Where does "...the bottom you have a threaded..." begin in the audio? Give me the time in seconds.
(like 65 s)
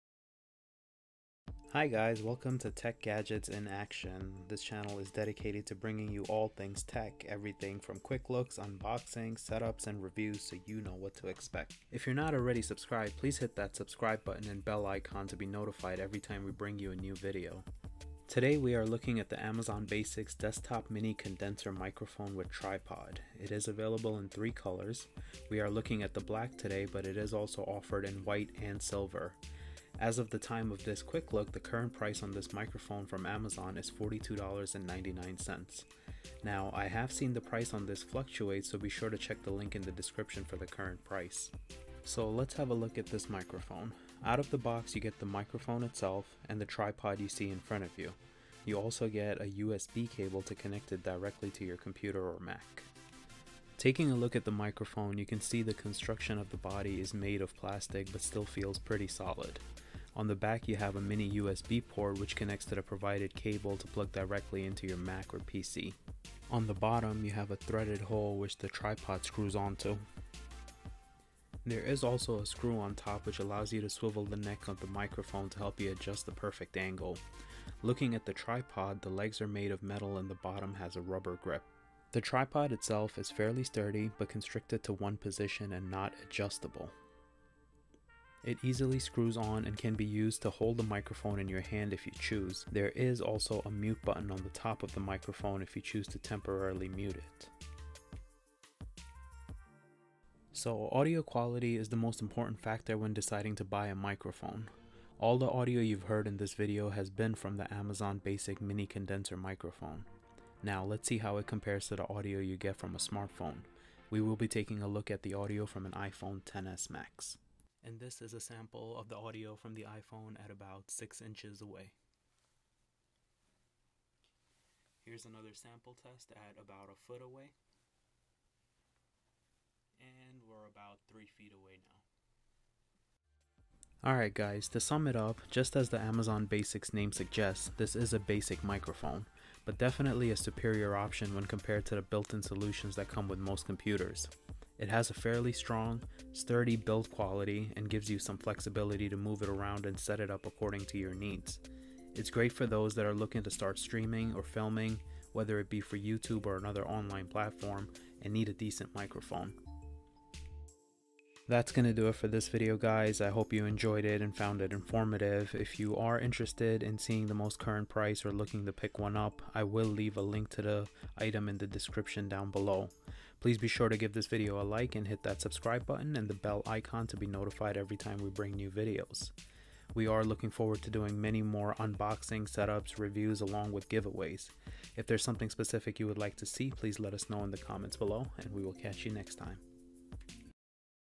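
66 s.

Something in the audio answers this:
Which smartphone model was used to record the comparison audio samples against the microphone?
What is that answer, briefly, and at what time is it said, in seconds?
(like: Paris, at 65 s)
iPhone XS Max, at 115 s.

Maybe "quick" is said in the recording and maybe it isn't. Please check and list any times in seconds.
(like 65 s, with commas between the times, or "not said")
8 s, 31 s.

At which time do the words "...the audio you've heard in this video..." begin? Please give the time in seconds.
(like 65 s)
105 s.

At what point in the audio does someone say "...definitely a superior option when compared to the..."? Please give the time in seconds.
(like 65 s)
139 s.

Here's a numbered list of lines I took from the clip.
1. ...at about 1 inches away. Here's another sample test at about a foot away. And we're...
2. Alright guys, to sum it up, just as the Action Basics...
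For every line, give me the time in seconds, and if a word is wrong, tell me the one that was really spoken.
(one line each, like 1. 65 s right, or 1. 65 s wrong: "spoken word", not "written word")
1. 120 s wrong: "6", not "1"
2. 134 s wrong: "Amazon", not "Action".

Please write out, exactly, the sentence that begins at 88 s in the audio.
It easily screws on and can be used to hold the microphone in your hand if you choose.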